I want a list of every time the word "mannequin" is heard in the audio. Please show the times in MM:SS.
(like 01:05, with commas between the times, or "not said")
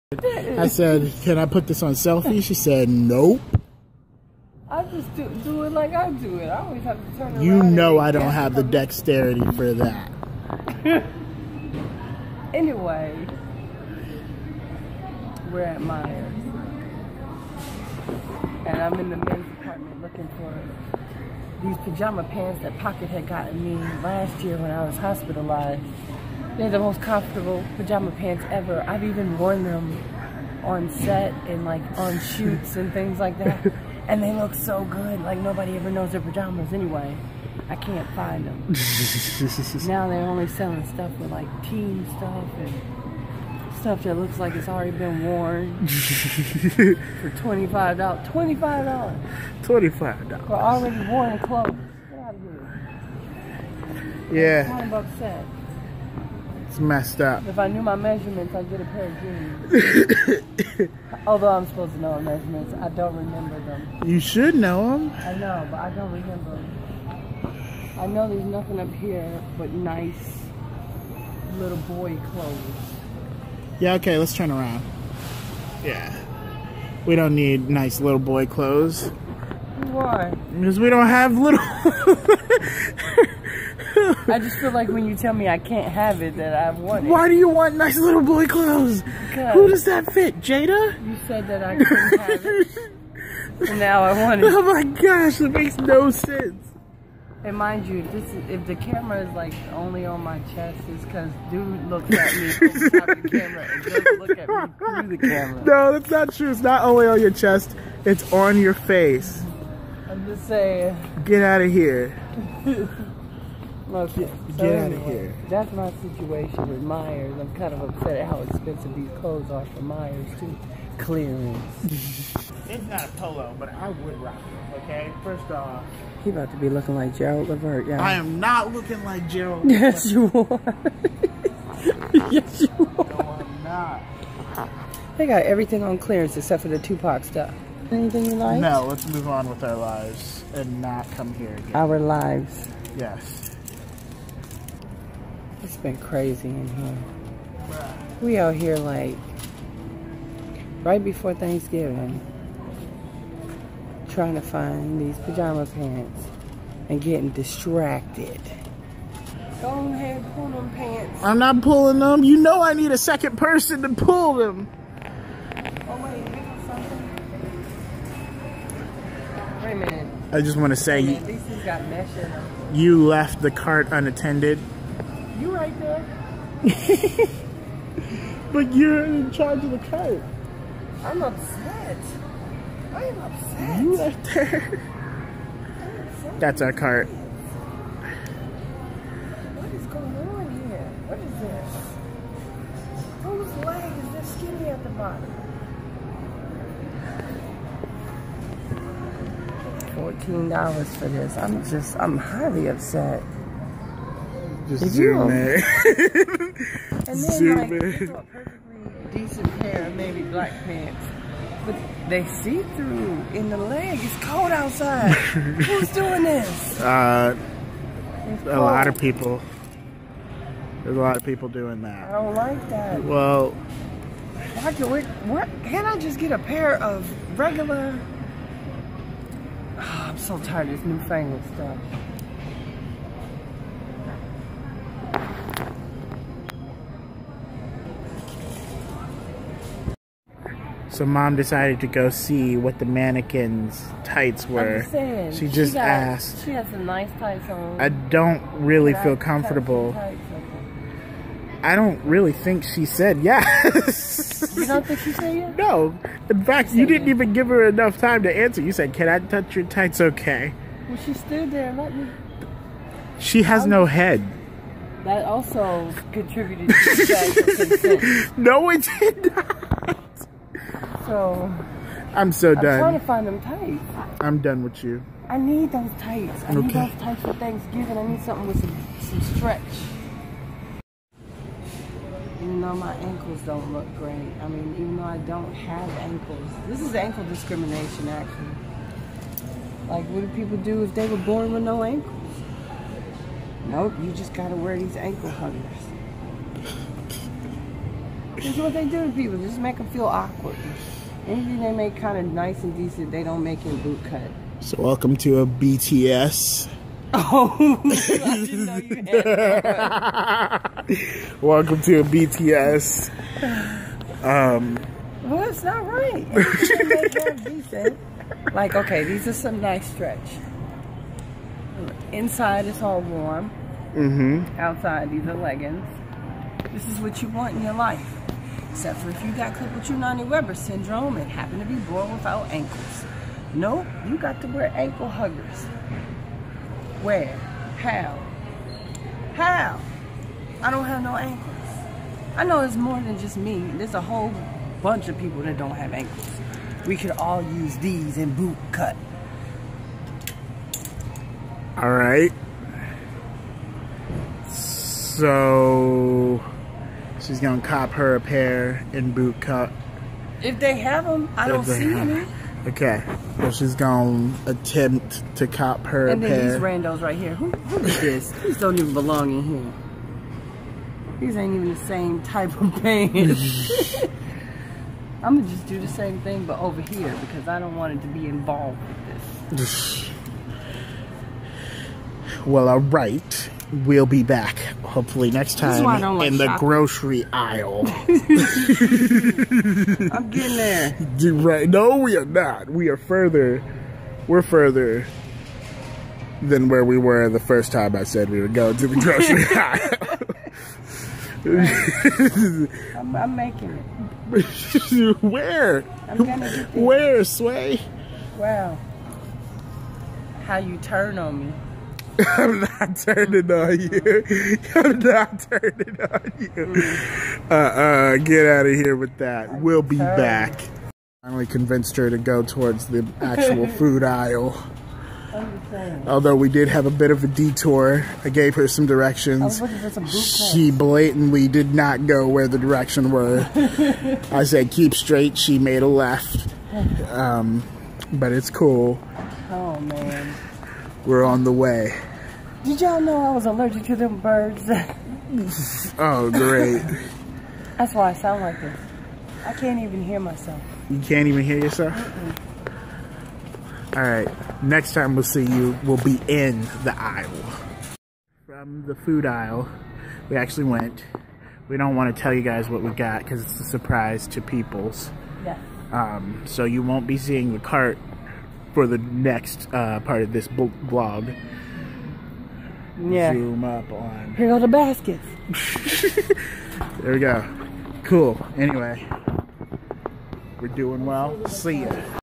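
04:02.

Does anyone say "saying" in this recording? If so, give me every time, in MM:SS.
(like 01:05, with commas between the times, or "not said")
01:50, 04:04.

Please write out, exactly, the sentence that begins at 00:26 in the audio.
They're the most comfortable pajama pants ever.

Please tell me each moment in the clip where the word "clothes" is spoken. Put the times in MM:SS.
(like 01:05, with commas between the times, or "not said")
00:51, 01:12, 01:18, 01:28, 01:59.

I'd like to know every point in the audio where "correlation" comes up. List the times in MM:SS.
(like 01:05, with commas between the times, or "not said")
not said.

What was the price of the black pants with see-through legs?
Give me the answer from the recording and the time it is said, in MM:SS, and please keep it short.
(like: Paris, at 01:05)
$14, at 03:19.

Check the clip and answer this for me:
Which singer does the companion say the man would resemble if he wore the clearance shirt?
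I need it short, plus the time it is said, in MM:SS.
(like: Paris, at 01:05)
Gerald Levert, at 02:07.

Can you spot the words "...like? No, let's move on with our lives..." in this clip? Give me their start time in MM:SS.
02:18.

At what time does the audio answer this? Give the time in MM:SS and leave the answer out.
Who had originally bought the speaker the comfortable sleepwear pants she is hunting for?
00:22.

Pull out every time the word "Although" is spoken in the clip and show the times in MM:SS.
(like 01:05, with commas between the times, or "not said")
01:01, 07:06.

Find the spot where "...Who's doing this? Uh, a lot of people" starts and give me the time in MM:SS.
03:35.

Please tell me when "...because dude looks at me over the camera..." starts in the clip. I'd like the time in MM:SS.
01:41.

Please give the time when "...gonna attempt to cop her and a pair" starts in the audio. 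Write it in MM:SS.
06:03.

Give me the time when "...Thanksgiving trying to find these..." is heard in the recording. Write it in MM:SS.
02:31.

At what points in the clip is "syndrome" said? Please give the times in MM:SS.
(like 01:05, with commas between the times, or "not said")
05:30.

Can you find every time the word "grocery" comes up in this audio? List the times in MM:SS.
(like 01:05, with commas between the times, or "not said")
06:26, 06:38.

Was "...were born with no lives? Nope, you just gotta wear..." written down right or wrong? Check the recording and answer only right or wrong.
wrong.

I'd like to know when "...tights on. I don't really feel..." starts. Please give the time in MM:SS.
04:07.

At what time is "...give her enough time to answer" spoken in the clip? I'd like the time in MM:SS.
04:17.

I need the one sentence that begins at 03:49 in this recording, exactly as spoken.
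Oh, I'm so tired of this newfangled stuff.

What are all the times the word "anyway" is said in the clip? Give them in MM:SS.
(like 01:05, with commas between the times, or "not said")
00:12, 00:36, 07:58.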